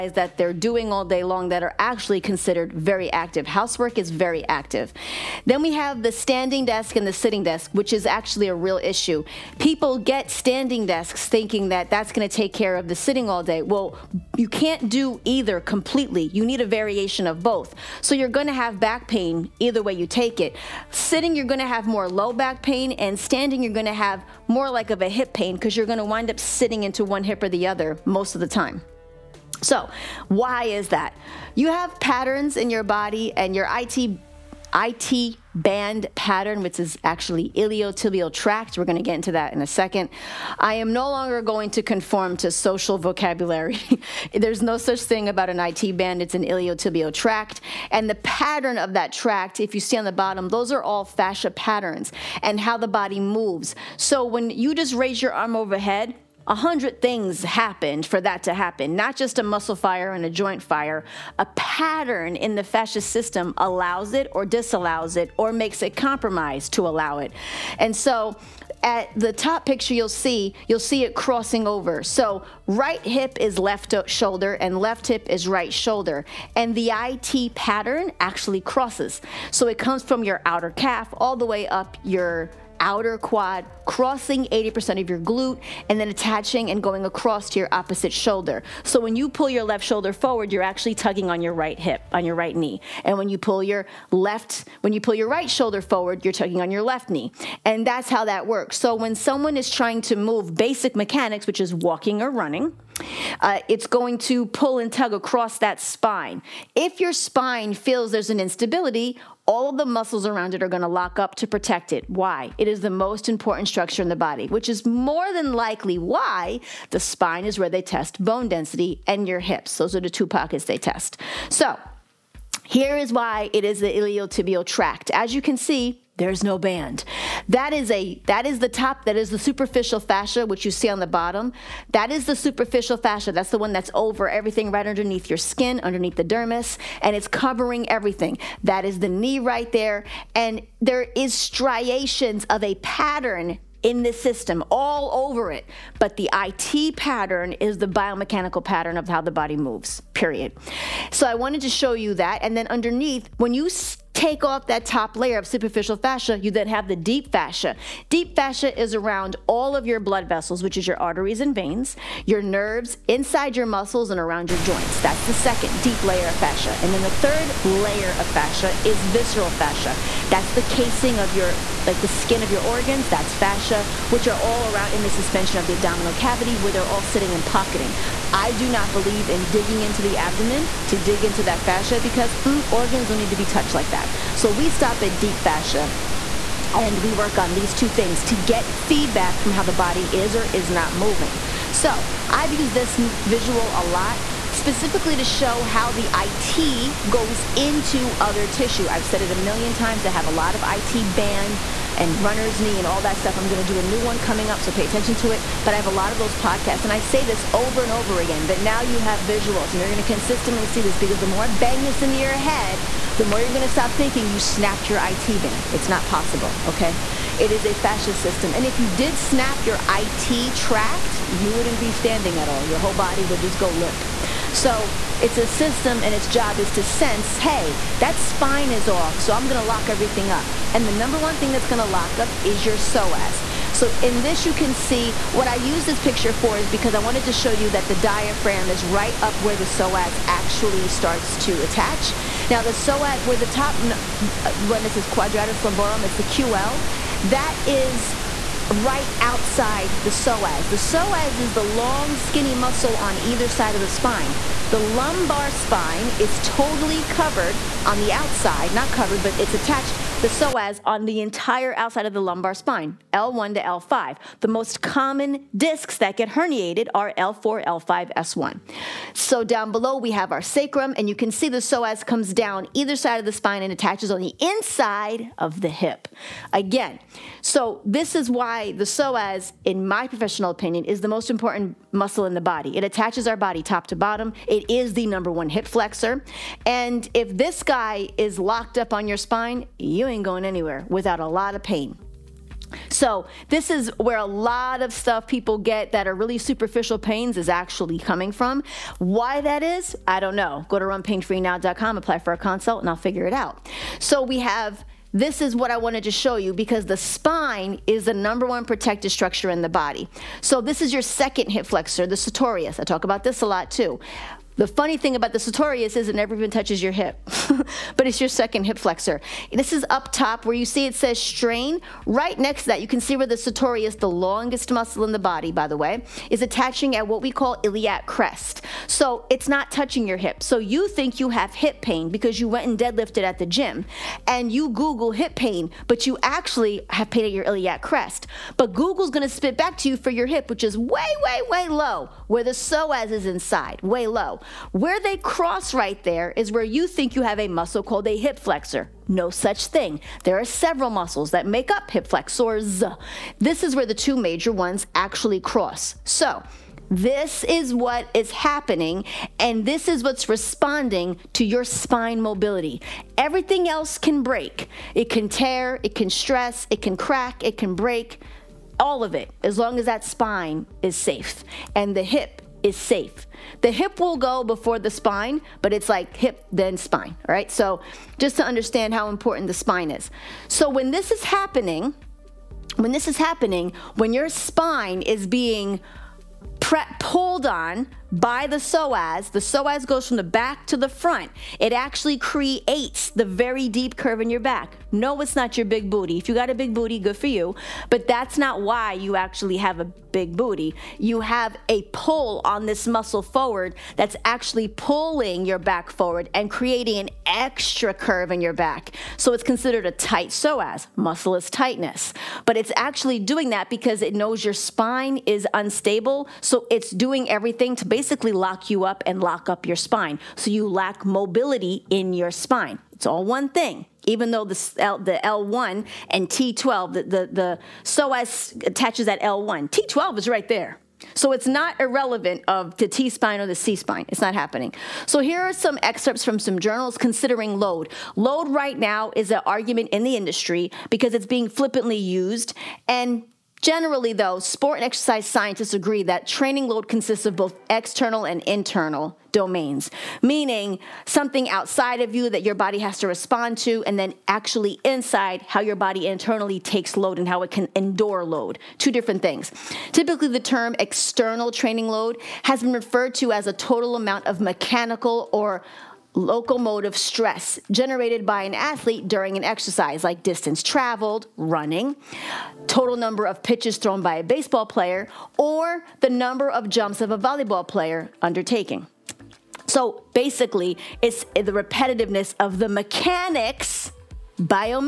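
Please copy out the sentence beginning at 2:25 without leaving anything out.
But the IT pattern is the biomechanical pattern of how the body moves, period.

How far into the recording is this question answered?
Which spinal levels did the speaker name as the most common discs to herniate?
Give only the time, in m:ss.
4:27.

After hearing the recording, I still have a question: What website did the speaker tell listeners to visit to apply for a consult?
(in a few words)
runpainfreenow.com.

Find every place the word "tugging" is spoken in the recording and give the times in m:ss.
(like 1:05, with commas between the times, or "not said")
1:30, 1:36.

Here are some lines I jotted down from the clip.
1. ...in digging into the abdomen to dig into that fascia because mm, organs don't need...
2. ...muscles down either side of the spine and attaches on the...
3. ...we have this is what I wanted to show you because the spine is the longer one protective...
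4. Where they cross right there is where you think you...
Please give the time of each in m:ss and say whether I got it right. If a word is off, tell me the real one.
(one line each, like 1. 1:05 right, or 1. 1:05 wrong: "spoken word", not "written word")
1. 2:59 right
2. 4:32 wrong: "comes", not "muscles"
3. 5:04 wrong: "number", not "longer"
4. 5:44 right.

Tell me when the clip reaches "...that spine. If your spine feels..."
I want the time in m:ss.
1:45.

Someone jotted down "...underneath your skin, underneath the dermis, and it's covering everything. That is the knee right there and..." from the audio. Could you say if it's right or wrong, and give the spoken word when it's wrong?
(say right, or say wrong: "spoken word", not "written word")
right.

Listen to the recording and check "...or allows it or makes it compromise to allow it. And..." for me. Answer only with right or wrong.
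wrong.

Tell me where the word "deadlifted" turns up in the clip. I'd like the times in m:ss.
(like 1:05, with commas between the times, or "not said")
5:32.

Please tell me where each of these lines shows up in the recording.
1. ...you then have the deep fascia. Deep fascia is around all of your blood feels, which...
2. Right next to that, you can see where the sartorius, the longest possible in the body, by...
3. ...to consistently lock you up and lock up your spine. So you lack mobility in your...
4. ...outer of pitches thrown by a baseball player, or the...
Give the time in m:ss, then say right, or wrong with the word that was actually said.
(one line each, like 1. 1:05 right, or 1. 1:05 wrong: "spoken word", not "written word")
1. 2:36 wrong: "vessels", not "feels"
2. 5:22 wrong: "muscle", not "possible"
3. 6:57 wrong: "basically", not "consistently"
4. 7:52 wrong: "number", not "outer".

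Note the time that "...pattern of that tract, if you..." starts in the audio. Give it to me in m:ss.
0:48.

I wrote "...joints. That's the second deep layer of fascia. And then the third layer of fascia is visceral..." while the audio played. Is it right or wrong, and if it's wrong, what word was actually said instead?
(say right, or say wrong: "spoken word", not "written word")
right.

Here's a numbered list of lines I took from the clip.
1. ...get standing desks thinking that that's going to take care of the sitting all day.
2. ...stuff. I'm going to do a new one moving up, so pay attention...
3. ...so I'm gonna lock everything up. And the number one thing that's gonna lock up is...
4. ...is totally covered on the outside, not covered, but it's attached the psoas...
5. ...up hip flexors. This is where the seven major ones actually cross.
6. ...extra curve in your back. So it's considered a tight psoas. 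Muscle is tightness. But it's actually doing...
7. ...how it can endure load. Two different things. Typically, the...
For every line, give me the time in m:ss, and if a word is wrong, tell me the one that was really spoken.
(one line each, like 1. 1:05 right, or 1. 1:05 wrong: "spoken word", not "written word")
1. 0:09 right
2. 3:23 wrong: "coming", not "moving"
3. 3:49 right
4. 4:16 right
5. 5:51 wrong: "two", not "seven"
6. 6:47 right
7. 7:37 right.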